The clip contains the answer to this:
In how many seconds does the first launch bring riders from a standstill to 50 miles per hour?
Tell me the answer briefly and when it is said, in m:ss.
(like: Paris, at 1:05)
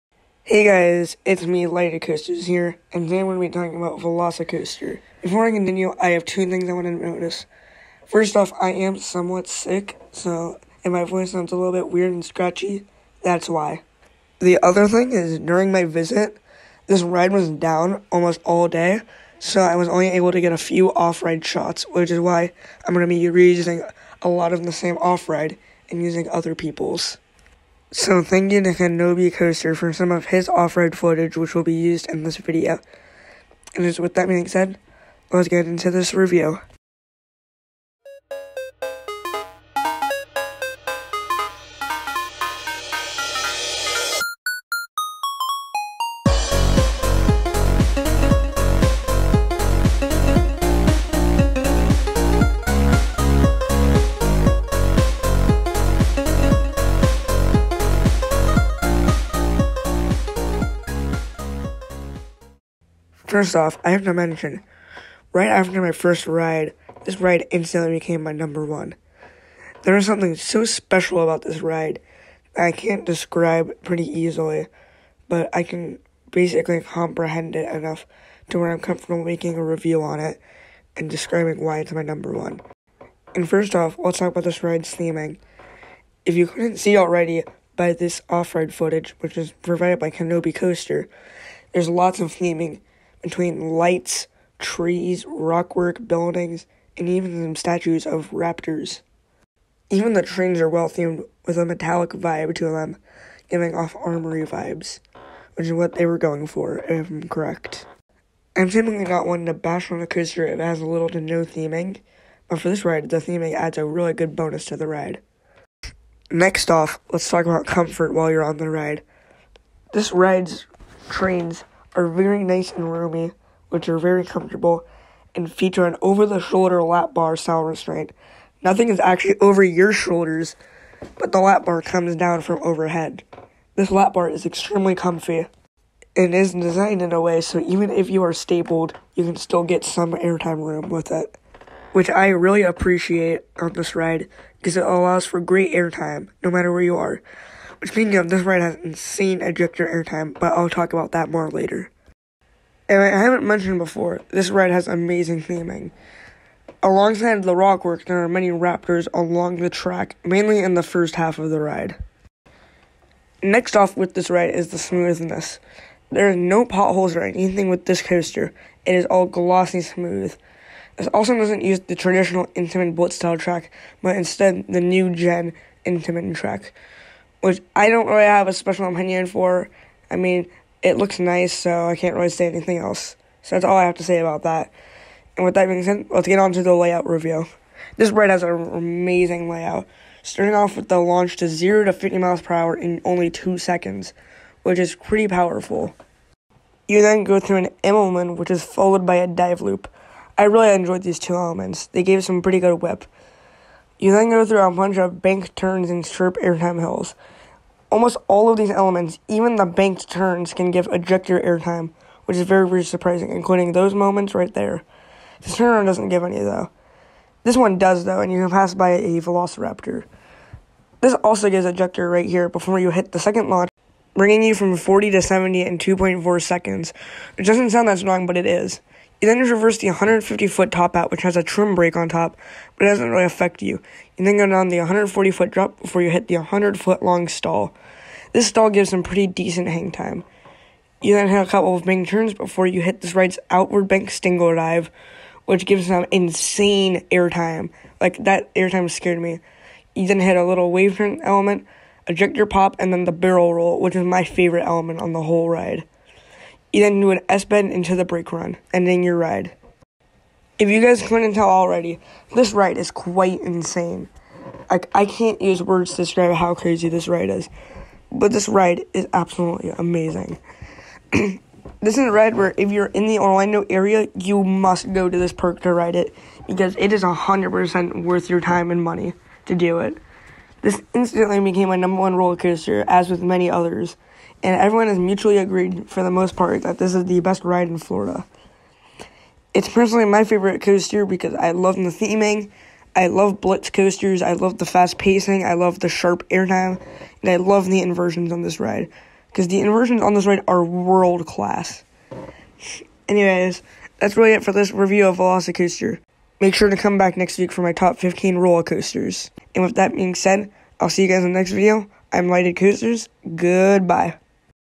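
2 seconds, at 3:13.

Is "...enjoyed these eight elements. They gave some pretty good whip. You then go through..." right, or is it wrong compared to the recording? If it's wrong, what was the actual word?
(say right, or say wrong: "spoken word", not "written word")
wrong: "two", not "eight".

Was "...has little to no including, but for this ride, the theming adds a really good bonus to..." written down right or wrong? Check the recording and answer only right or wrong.
wrong.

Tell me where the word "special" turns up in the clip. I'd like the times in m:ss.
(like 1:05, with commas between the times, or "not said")
1:10, 2:58.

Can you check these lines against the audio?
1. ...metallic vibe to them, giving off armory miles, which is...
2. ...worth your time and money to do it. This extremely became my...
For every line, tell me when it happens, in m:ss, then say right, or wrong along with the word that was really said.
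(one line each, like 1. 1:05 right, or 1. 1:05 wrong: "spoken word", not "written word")
1. 1:41 wrong: "vibes", not "miles"
2. 4:38 wrong: "instantly", not "extremely".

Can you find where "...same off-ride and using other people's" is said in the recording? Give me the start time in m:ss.
0:24.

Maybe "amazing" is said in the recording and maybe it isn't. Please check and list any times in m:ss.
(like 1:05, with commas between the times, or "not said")
2:34, 3:08, 4:29.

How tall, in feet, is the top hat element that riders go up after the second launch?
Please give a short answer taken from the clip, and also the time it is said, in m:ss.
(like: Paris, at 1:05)
150 feet, at 3:49.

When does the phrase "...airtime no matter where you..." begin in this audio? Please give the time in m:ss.
2:25.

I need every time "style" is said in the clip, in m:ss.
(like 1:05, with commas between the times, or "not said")
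2:07, 2:53.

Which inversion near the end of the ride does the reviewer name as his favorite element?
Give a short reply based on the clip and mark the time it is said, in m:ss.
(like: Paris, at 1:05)
barrel roll, at 4:13.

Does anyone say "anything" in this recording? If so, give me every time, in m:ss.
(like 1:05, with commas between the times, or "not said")
2:47, 3:02.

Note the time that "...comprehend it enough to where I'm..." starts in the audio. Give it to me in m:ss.
1:16.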